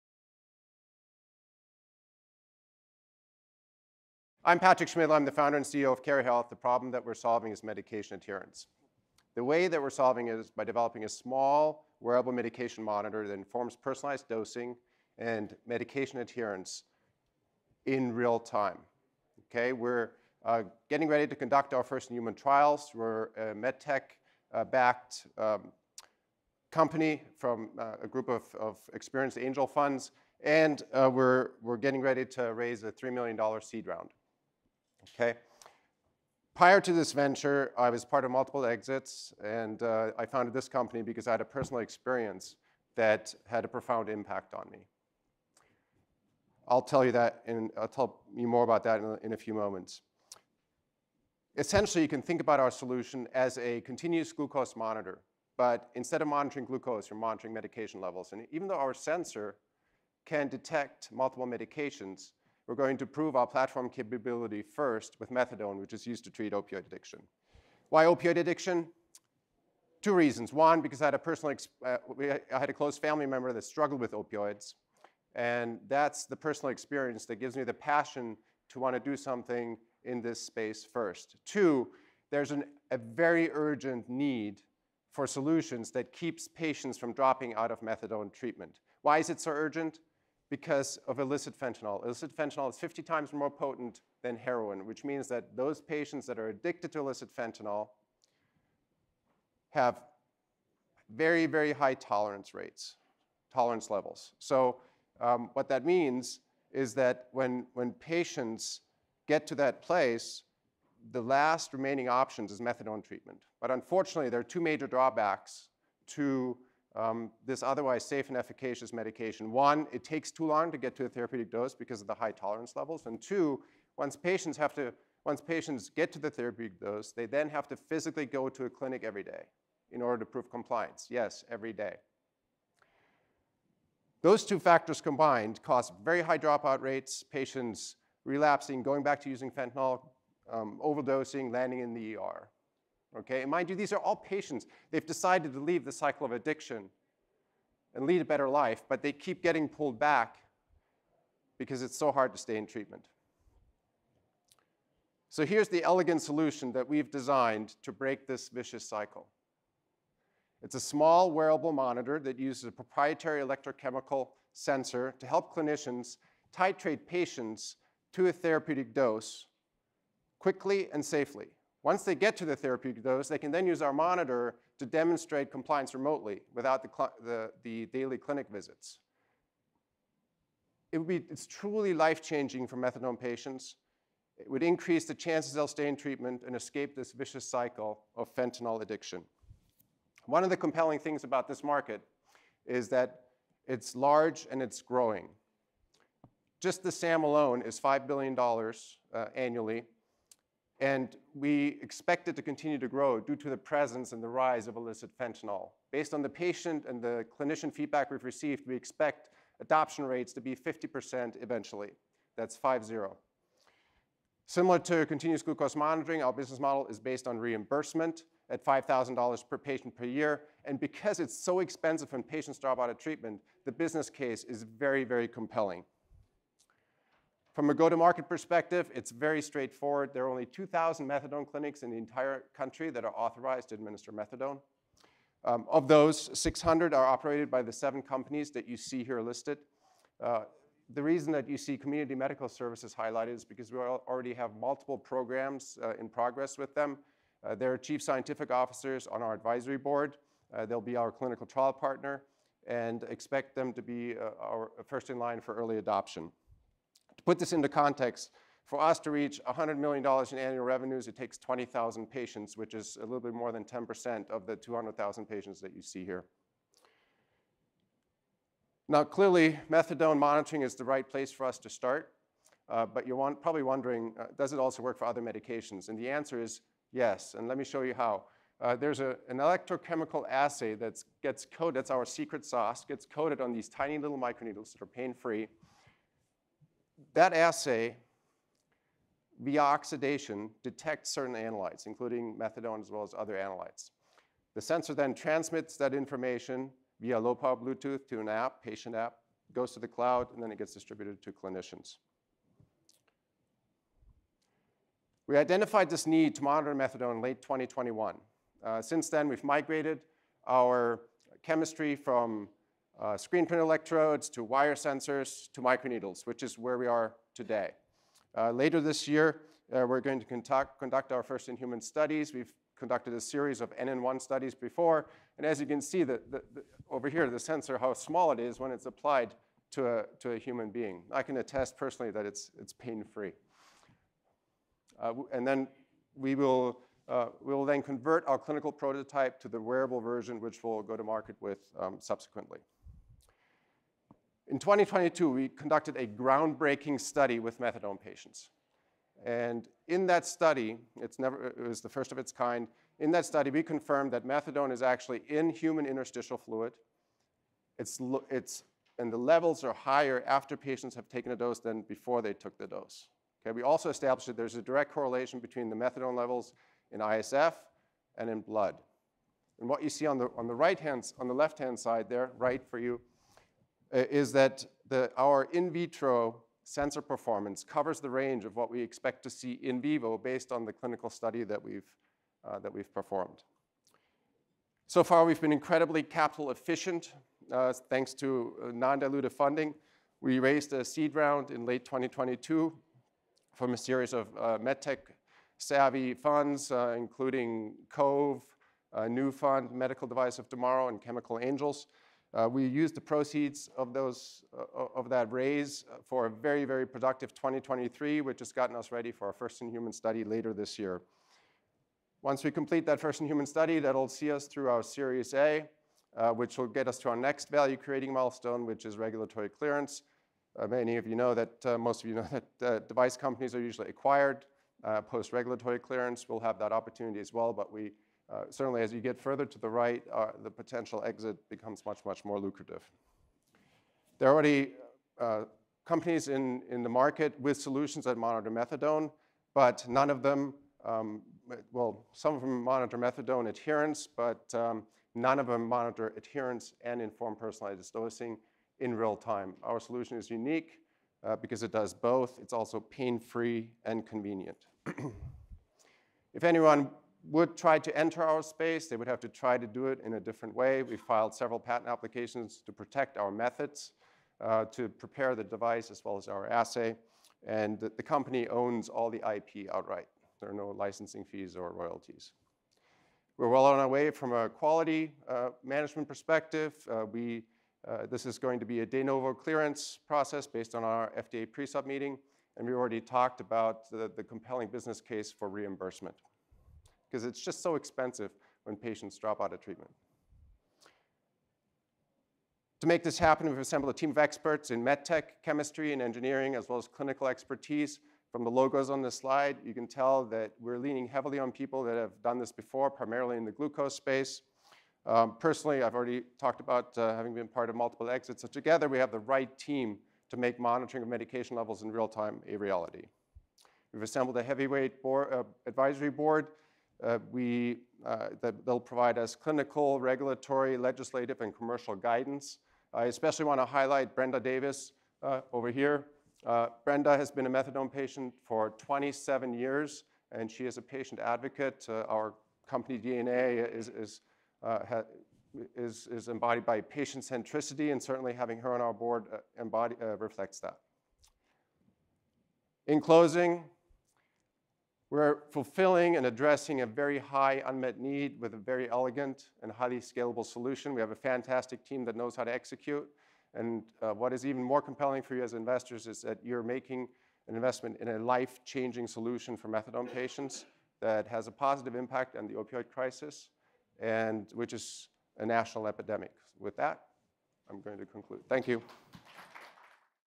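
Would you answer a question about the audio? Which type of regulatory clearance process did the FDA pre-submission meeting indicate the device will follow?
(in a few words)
de novo.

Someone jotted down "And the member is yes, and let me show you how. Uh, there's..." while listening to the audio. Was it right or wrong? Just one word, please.
wrong.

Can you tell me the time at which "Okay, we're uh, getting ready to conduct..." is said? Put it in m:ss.
0:19.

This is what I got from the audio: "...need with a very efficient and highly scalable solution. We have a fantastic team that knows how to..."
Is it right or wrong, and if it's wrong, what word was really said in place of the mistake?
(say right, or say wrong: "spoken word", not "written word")
wrong: "elegant", not "efficient".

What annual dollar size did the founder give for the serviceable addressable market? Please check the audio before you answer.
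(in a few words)
$5 billion.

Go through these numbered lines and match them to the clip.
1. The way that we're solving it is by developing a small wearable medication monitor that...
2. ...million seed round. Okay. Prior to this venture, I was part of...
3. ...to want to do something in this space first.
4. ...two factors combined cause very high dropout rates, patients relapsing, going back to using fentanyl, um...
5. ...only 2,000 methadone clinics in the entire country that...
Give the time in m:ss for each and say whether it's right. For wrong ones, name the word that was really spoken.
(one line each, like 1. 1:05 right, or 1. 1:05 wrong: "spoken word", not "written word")
1. 0:09 right
2. 0:33 right
3. 1:18 right
4. 2:14 right
5. 3:50 right.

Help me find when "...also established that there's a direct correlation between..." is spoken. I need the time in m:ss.
6:03.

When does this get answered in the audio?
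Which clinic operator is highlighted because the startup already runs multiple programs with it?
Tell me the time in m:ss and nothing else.
4:01.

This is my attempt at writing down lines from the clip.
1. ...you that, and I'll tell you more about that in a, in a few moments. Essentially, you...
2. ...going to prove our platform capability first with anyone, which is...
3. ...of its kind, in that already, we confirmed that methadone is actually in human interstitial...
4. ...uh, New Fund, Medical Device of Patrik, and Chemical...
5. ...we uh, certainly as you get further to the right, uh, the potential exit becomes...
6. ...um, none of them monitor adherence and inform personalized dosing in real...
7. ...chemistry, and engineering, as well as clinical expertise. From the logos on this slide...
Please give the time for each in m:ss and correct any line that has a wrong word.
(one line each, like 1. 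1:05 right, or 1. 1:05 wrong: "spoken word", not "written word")
1. 0:47 right
2. 1:02 wrong: "methadone", not "anyone"
3. 5:52 wrong: "study", not "already"
4. 6:38 wrong: "Tomorrow", not "Patrik"
5. 7:07 right
6. 7:24 right
7. 8:15 right.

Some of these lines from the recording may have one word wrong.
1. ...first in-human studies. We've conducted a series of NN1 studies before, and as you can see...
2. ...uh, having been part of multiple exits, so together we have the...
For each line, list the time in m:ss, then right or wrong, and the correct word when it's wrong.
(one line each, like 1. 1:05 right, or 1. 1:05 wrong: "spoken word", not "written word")
1. 5:21 right
2. 8:26 right.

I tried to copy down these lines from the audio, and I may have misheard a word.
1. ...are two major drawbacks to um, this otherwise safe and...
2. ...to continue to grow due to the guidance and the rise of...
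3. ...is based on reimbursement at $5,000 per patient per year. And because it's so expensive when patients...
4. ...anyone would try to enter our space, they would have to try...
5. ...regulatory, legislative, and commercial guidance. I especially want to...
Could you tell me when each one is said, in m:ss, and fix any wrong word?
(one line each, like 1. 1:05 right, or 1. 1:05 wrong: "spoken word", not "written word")
1. 1:54 right
2. 3:22 wrong: "presence", not "guidance"
3. 3:36 right
4. 7:36 right
5. 8:39 right.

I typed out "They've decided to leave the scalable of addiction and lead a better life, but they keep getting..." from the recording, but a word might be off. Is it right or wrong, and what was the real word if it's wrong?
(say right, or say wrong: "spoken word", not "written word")
wrong: "cycle", not "scalable".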